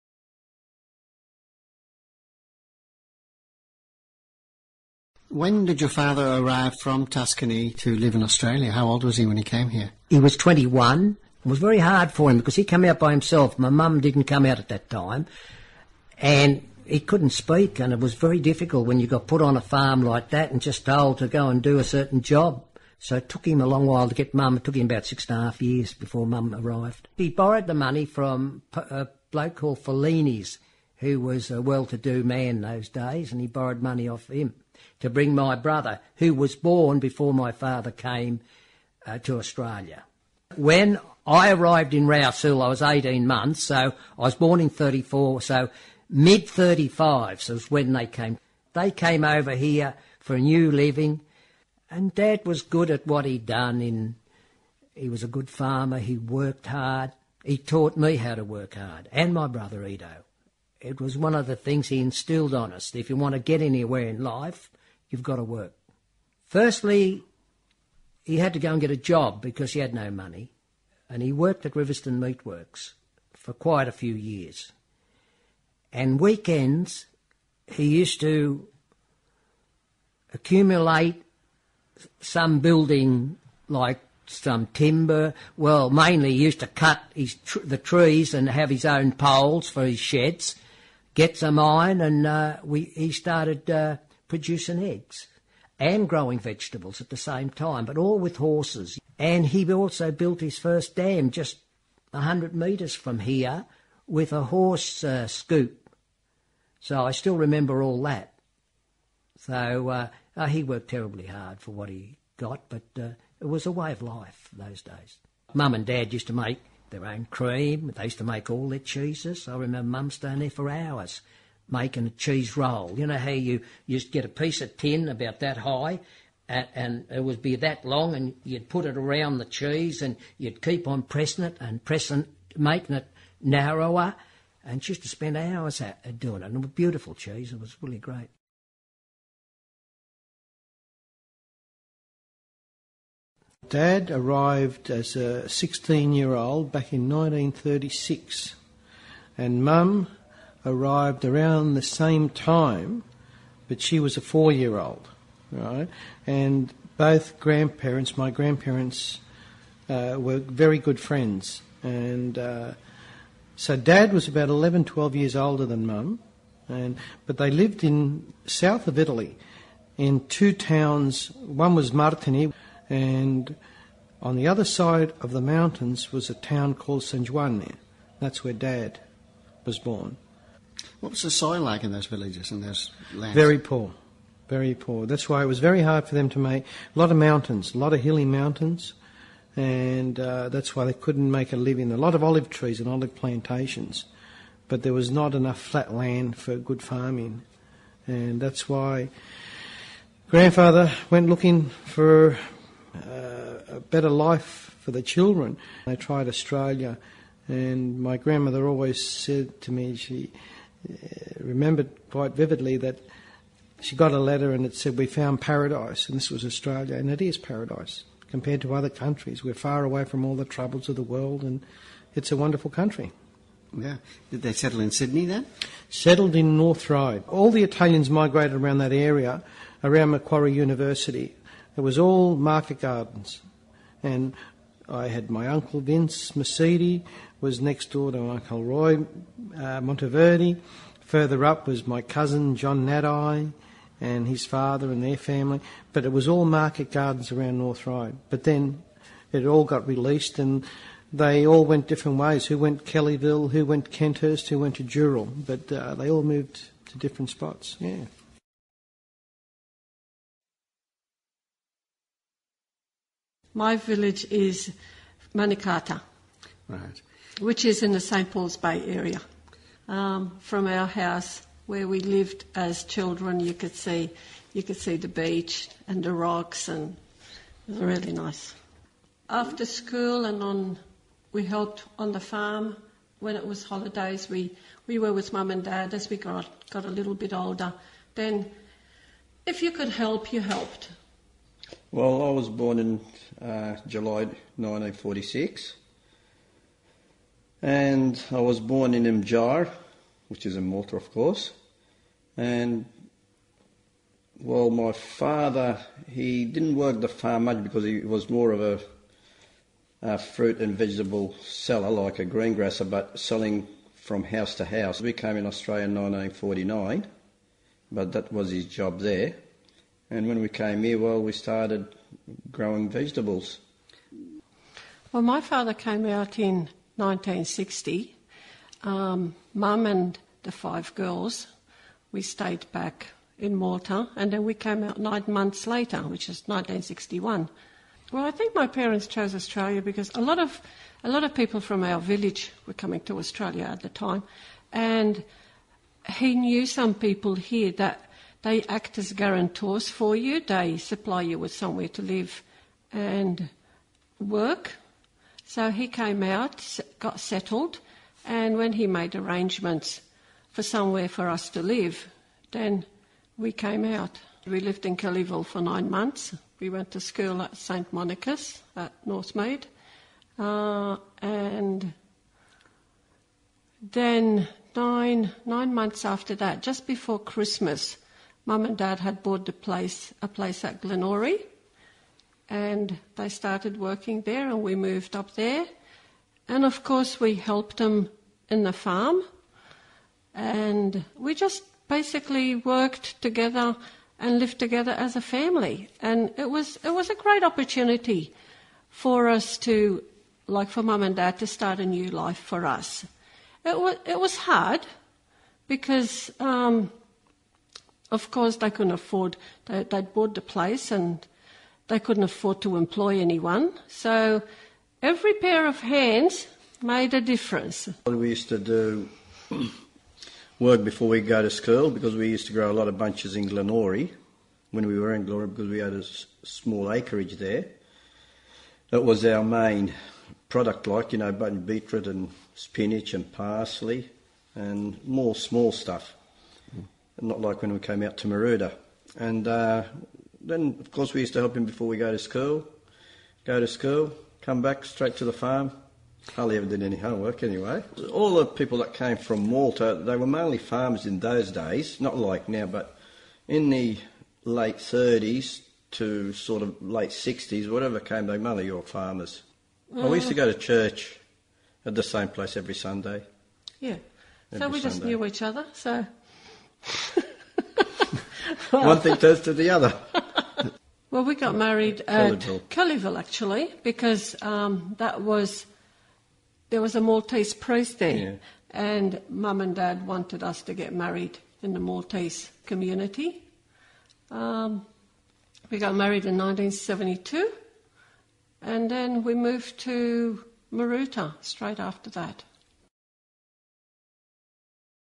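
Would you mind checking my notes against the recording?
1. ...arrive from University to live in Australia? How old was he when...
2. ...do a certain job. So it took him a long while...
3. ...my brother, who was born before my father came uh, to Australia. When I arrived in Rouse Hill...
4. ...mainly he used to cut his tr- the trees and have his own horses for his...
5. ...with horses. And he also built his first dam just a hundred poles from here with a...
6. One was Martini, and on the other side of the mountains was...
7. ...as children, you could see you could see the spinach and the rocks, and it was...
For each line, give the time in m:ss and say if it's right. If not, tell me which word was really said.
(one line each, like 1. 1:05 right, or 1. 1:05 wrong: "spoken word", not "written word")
1. 0:06 wrong: "Tuscany", not "University"
2. 0:21 right
3. 0:35 right
4. 1:25 wrong: "poles", not "horses"
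5. 1:38 wrong: "metres", not "poles"
6. 2:51 right
7. 4:32 wrong: "beach", not "spinach".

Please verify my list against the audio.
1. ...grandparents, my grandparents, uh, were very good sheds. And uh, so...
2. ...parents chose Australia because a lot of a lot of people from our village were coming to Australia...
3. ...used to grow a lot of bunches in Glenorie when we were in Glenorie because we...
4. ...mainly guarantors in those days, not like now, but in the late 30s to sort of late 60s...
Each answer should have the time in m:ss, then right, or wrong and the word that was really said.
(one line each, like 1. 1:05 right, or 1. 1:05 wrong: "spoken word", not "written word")
1. 2:37 wrong: "friends", not "sheds"
2. 5:38 right
3. 7:02 right
4. 7:30 wrong: "farmers", not "guarantors".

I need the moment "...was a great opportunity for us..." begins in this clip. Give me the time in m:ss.
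6:36.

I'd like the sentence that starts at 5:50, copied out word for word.
They supply you with somewhere to live and work.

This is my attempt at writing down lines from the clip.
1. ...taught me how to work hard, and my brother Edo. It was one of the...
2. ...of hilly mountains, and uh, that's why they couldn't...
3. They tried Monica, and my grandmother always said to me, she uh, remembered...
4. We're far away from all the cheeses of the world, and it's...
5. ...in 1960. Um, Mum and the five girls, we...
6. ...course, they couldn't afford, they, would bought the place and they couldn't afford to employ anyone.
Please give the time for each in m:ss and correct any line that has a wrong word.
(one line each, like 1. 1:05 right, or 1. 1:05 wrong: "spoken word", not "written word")
1. 0:57 right
2. 3:07 right
3. 3:25 wrong: "Australia", not "Monica"
4. 3:39 wrong: "troubles", not "cheeses"
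5. 5:26 right
6. 6:48 right.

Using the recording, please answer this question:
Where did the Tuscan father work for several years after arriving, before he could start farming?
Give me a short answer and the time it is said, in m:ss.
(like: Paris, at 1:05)
Riverstone Meatworks, at 1:11.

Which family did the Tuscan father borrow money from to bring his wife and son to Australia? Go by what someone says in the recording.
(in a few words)
Fellini's.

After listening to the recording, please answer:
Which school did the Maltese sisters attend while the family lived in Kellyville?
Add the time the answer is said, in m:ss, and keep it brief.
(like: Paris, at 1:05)
St Monica's, at 6:07.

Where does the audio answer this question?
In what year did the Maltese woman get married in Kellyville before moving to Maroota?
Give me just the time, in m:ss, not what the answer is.
8:06.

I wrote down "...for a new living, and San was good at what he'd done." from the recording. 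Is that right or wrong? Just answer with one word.
wrong.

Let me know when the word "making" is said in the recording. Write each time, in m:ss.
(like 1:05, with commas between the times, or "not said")
2:01, 2:12.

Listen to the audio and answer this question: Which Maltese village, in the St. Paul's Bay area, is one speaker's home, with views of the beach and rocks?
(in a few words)
Manikata.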